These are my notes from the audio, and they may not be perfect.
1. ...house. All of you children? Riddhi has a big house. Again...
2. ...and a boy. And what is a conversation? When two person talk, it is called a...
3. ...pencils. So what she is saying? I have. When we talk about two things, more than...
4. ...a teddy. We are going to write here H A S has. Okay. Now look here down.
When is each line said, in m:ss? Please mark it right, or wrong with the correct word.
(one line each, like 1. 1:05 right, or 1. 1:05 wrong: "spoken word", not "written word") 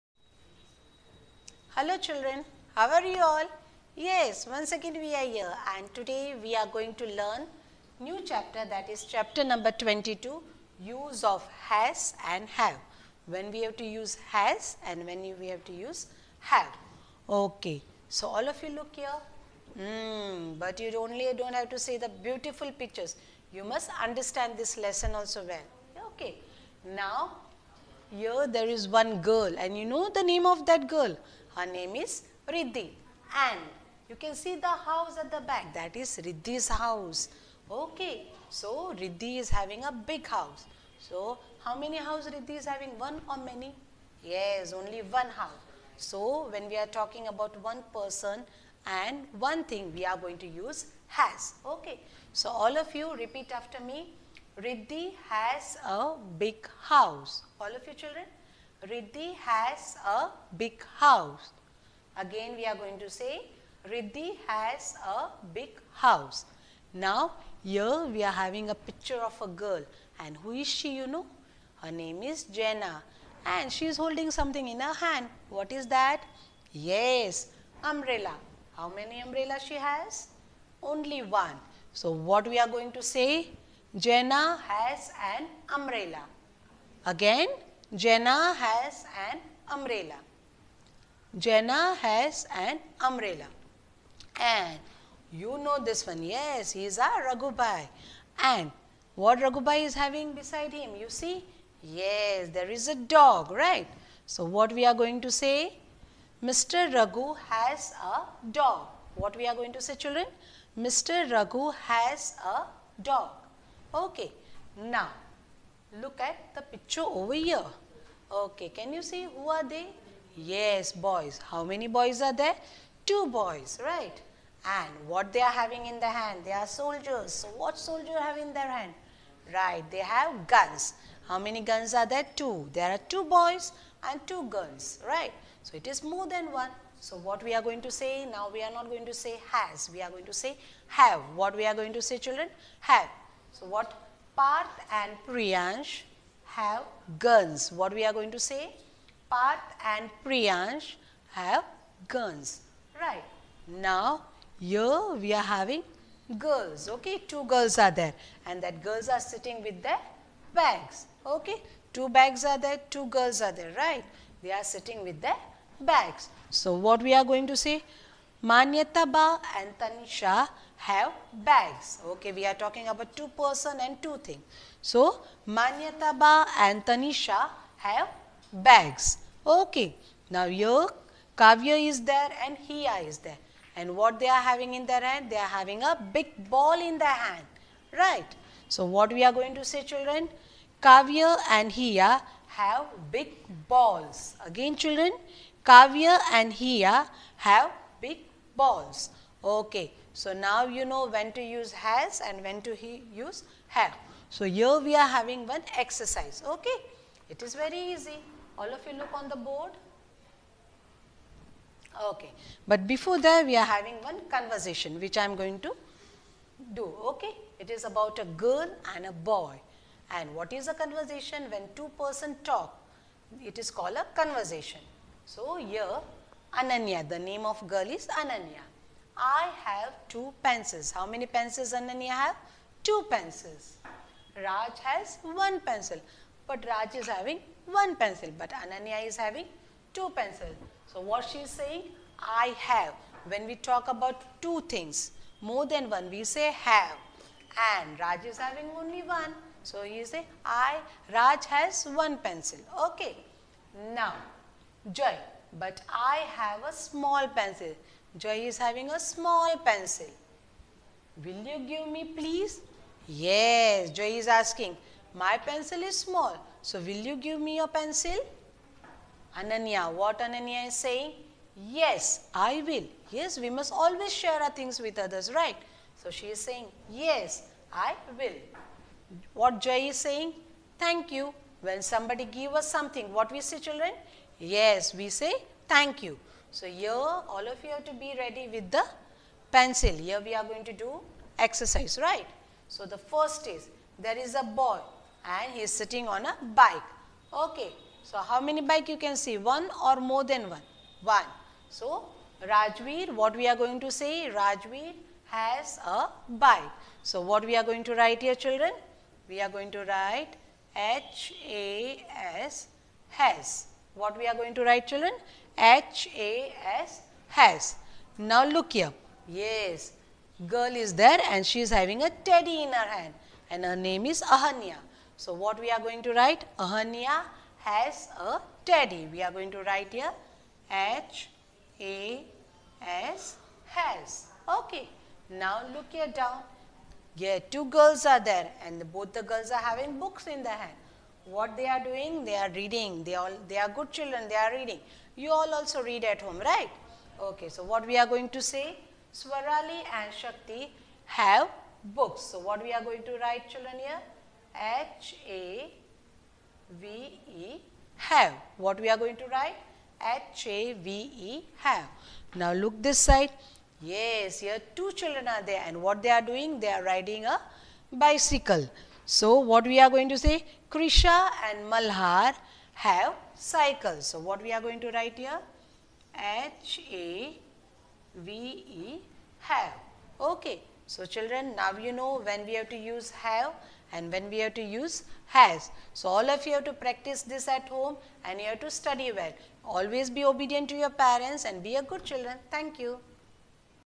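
1. 0:56 right
2. 3:38 right
3. 4:00 right
4. 5:28 right.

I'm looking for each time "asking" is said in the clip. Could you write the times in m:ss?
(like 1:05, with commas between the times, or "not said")
4:24.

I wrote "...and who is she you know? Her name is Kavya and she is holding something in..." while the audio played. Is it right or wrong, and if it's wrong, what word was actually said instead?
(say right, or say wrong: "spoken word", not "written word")
wrong: "Jenna", not "Kavya".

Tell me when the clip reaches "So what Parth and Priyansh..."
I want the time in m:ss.
2:23.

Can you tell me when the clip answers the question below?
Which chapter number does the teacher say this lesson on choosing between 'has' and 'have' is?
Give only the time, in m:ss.
0:09.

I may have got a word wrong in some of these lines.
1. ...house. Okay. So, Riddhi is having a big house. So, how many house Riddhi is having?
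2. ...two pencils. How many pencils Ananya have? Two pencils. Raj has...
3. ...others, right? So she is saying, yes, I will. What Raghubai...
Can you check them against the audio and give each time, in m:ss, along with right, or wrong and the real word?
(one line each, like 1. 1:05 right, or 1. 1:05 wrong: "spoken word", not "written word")
1. 0:36 right
2. 3:50 right
3. 4:34 wrong: "Joy", not "Raghubai".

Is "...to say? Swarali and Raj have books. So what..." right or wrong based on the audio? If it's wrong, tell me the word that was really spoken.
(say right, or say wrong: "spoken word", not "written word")
wrong: "Shakti", not "Raj".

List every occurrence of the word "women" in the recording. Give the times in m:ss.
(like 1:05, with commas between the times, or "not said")
not said.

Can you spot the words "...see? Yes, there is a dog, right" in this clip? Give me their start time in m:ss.
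1:41.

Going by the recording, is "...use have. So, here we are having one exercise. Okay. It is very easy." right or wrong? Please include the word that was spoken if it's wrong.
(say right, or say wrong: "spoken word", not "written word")
right.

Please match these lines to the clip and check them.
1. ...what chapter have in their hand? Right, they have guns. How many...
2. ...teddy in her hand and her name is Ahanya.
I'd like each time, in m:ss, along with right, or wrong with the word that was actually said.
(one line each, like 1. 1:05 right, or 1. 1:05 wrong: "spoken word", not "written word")
1. 2:07 wrong: "soldier", not "chapter"
2. 5:22 right.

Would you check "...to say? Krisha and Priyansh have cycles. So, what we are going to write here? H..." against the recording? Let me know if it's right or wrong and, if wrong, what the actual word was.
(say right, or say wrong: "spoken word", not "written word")
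wrong: "Malhar", not "Priyansh".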